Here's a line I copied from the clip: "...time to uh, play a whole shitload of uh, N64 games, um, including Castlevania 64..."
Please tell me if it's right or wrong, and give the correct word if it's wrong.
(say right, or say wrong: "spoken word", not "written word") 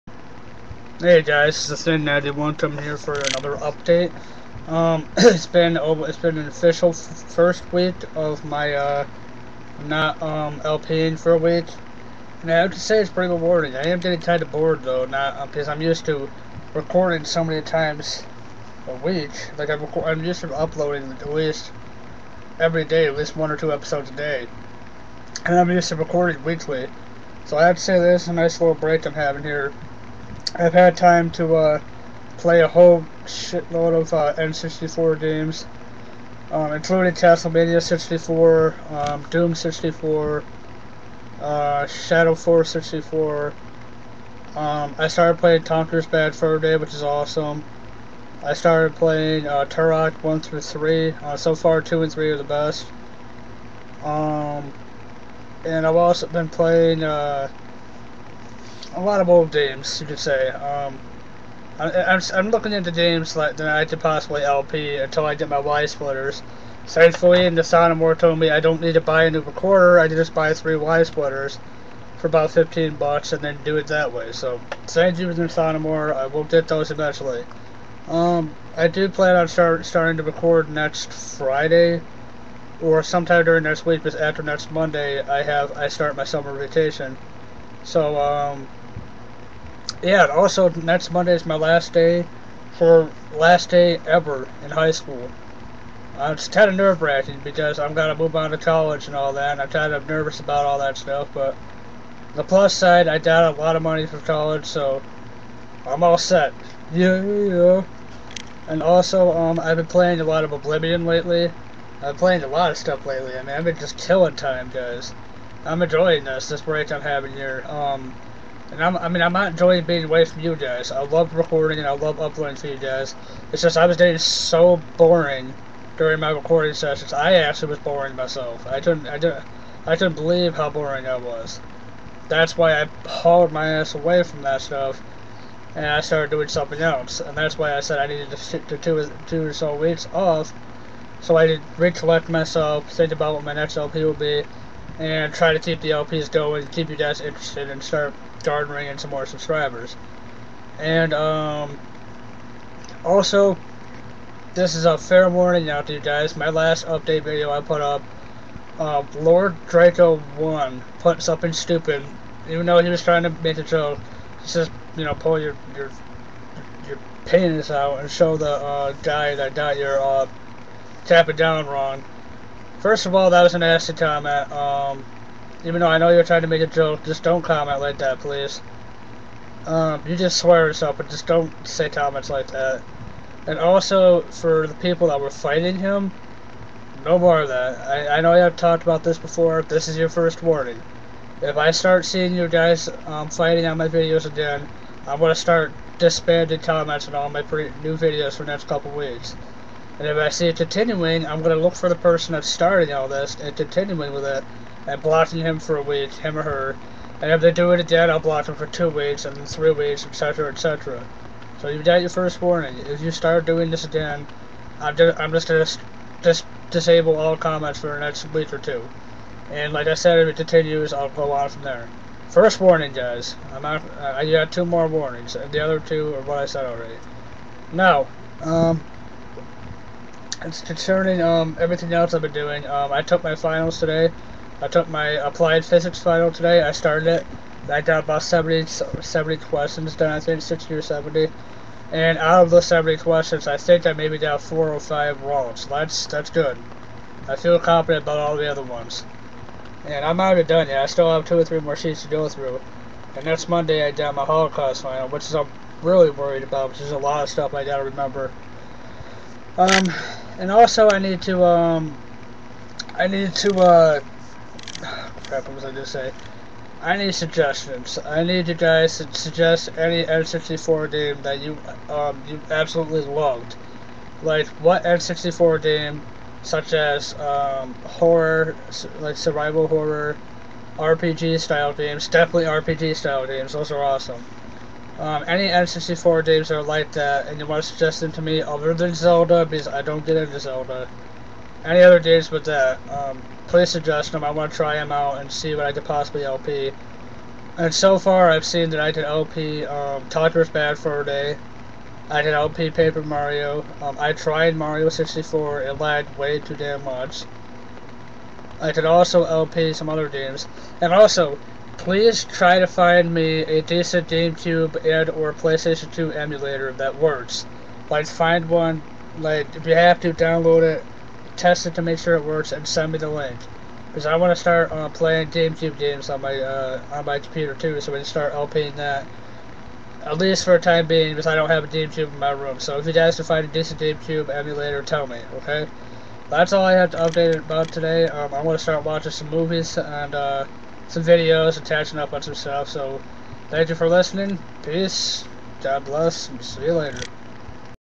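right.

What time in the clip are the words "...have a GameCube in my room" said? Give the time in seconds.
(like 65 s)
331 s.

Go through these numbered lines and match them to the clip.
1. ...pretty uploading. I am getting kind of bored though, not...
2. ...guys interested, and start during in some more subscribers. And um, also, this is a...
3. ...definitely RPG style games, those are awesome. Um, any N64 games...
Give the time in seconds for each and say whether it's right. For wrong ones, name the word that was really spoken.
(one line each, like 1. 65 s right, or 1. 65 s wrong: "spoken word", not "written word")
1. 13 s wrong: "rewarding", not "uploading"
2. 146 s wrong: "garnering", not "during"
3. 282 s right.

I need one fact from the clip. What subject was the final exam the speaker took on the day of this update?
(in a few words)
Applied physics.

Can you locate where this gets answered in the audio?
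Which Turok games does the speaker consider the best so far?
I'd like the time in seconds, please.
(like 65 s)
51 s.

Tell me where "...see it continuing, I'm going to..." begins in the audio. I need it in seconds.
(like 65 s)
200 s.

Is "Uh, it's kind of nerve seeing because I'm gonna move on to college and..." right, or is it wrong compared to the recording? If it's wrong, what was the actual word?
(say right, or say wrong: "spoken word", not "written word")
wrong: "wracking", not "seeing".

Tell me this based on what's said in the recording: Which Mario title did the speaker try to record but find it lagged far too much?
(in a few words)
Mario 64.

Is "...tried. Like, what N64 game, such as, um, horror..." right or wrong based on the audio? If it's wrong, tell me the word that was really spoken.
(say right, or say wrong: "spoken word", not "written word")
wrong: "loved", not "tried".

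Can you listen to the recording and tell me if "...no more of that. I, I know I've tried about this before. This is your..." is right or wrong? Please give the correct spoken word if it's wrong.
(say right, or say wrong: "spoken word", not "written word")
wrong: "talked", not "tried".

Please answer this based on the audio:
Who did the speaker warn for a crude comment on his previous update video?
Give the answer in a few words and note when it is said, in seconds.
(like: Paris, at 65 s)
Lord Draco 1, at 159 s.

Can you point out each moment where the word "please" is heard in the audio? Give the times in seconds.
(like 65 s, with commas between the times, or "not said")
178 s, 293 s, 311 s.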